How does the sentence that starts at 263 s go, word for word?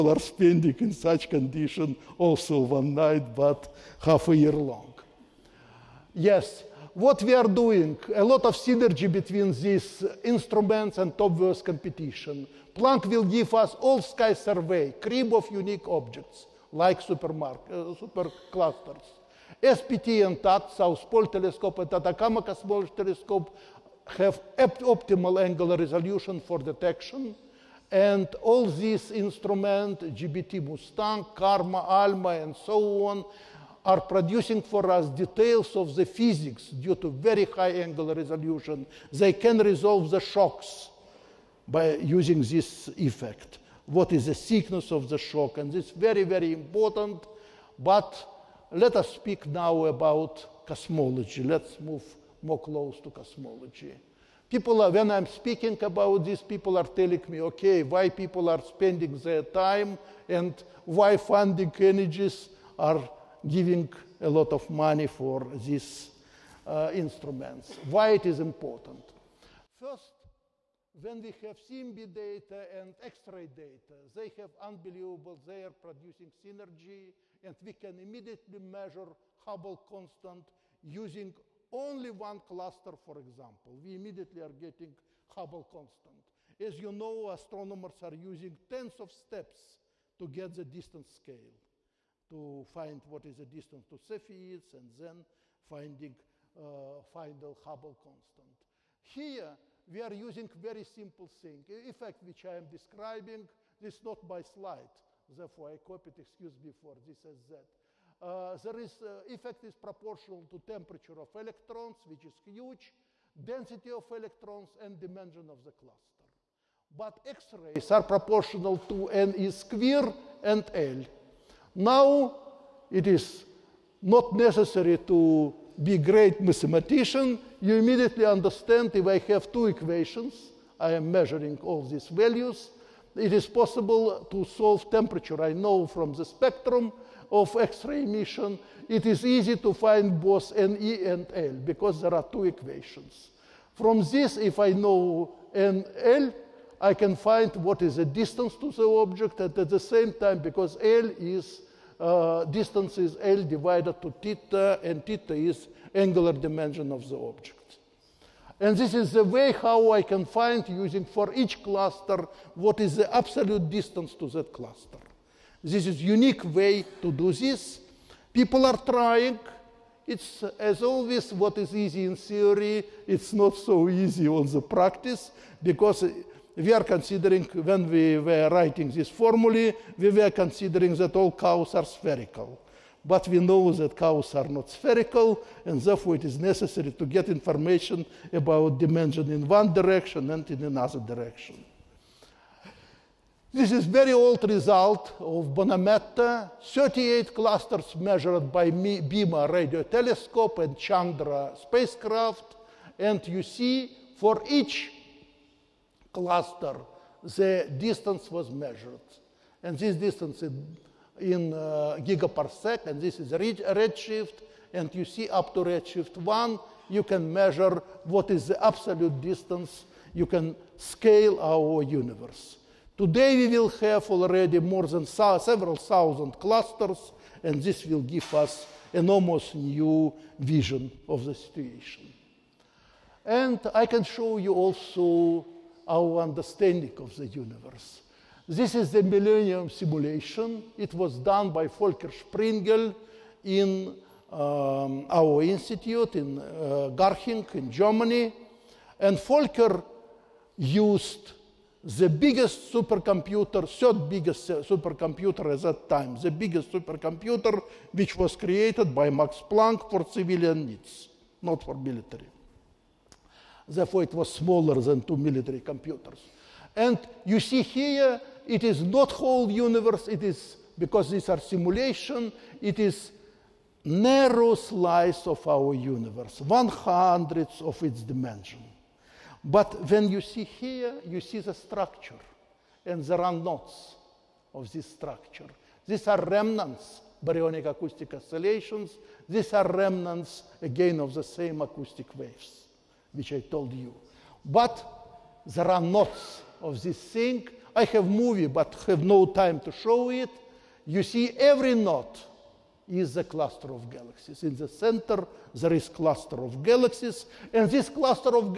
Therefore, it was smaller than two military computers.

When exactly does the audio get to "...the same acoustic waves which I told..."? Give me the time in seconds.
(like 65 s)
291 s.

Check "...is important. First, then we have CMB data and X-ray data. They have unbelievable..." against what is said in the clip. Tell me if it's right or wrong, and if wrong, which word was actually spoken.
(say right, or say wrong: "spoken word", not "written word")
right.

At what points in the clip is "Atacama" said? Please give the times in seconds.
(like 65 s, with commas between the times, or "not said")
21 s.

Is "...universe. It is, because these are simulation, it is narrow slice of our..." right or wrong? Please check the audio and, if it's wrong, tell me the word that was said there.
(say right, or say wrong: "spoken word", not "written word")
right.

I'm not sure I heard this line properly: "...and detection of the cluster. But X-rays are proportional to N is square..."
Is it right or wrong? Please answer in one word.
wrong.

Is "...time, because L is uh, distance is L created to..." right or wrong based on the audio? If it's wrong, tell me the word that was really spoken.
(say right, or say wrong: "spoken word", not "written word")
wrong: "divided", not "created".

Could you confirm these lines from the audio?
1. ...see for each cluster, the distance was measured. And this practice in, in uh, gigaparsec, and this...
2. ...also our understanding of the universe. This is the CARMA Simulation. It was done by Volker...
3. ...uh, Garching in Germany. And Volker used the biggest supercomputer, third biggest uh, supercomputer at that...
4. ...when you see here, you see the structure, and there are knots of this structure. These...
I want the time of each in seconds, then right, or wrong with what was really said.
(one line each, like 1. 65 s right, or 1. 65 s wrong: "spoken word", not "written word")
1. 203 s wrong: "distance", not "practice"
2. 234 s wrong: "Millennium", not "CARMA"
3. 246 s right
4. 279 s right.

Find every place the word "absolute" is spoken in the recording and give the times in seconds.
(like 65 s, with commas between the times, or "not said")
163 s, 218 s.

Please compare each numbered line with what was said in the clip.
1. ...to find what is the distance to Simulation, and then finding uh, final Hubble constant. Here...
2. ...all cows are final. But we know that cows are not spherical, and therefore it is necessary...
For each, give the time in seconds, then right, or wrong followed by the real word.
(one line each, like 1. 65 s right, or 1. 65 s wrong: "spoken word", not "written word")
1. 92 s wrong: "Cepheids", not "Simulation"
2. 181 s wrong: "spherical", not "final".